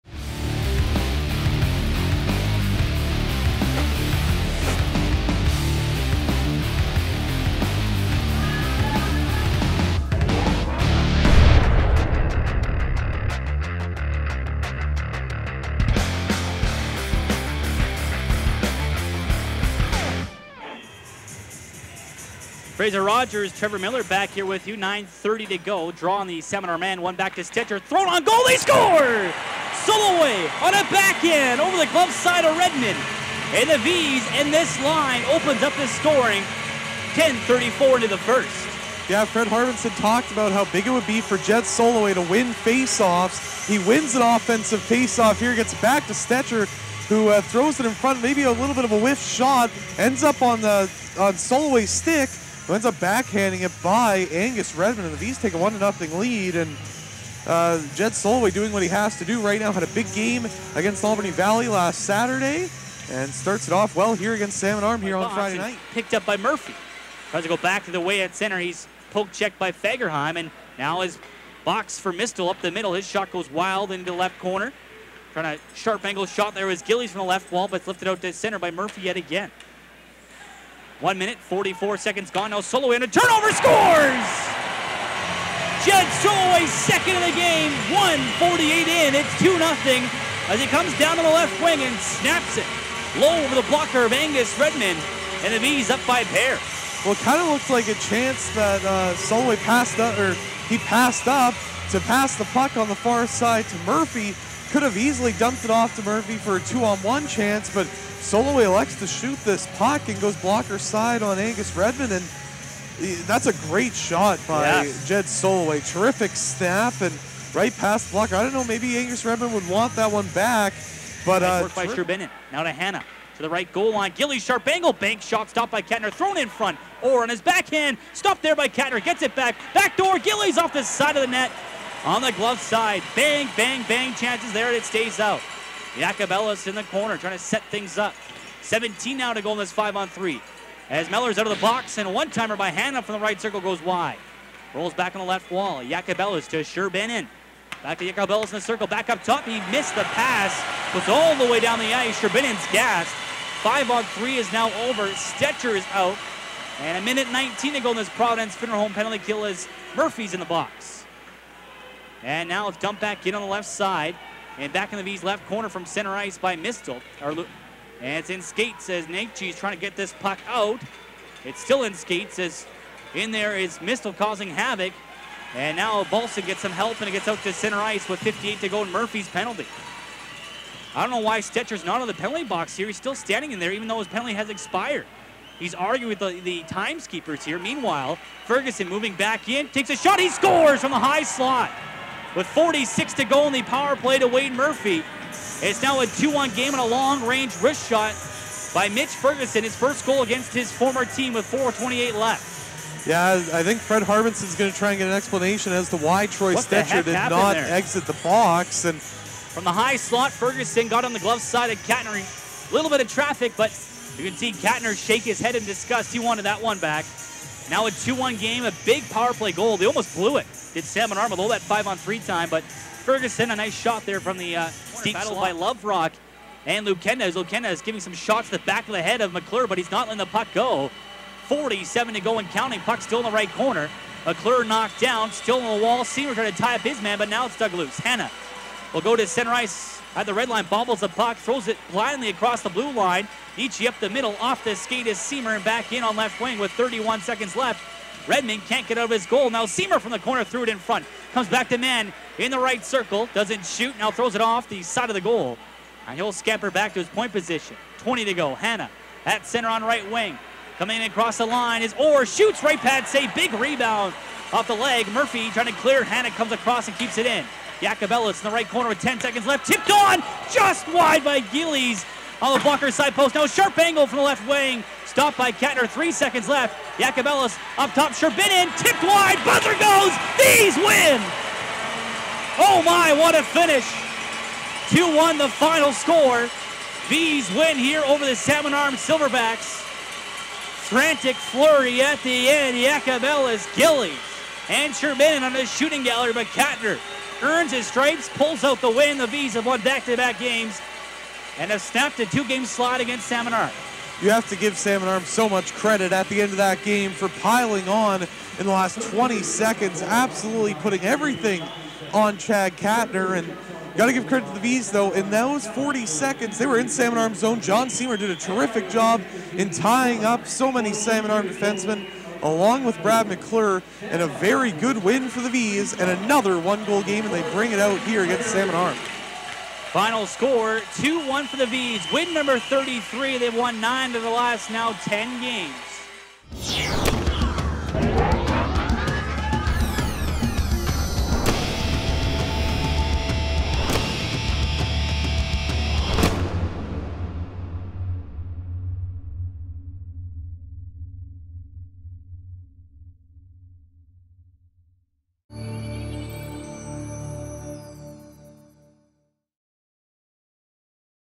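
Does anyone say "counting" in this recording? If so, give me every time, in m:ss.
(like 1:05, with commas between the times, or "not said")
3:52.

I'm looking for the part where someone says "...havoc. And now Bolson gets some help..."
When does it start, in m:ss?
2:54.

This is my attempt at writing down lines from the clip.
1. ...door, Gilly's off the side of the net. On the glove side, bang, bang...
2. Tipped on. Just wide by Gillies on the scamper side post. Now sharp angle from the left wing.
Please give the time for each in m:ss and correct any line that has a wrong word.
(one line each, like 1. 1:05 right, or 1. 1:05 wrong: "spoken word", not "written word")
1. 2:09 right
2. 4:29 wrong: "blocker", not "scamper".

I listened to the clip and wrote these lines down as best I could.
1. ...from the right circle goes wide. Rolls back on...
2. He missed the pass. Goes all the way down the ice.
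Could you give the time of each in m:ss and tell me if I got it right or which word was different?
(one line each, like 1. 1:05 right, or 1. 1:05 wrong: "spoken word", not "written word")
1. 2:23 right
2. 2:29 right.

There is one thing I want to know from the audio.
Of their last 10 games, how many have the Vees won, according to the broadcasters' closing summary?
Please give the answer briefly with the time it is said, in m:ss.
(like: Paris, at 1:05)
9, at 5:33.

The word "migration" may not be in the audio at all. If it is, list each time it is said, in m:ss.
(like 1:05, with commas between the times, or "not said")
not said.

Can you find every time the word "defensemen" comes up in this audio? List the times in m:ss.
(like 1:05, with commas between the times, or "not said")
5:21.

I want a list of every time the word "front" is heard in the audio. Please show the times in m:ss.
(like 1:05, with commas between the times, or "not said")
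0:47, 2:06, 4:10.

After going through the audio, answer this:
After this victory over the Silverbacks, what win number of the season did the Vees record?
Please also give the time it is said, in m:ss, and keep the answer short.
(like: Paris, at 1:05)
33, at 5:32.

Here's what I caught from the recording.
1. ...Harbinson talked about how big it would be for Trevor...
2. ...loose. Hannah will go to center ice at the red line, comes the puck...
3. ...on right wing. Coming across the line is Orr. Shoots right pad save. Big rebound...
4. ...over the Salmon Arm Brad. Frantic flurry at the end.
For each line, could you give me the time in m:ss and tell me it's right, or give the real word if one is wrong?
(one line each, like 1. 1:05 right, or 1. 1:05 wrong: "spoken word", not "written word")
1. 0:39 wrong: "Jed", not "Trevor"
2. 3:57 wrong: "bobbles", not "comes"
3. 4:19 right
4. 4:48 wrong: "Silverbacks", not "Brad".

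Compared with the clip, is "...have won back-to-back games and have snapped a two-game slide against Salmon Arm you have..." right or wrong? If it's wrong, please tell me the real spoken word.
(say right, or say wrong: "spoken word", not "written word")
right.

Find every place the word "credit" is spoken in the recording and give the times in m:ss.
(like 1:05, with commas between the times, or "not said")
5:05, 5:14.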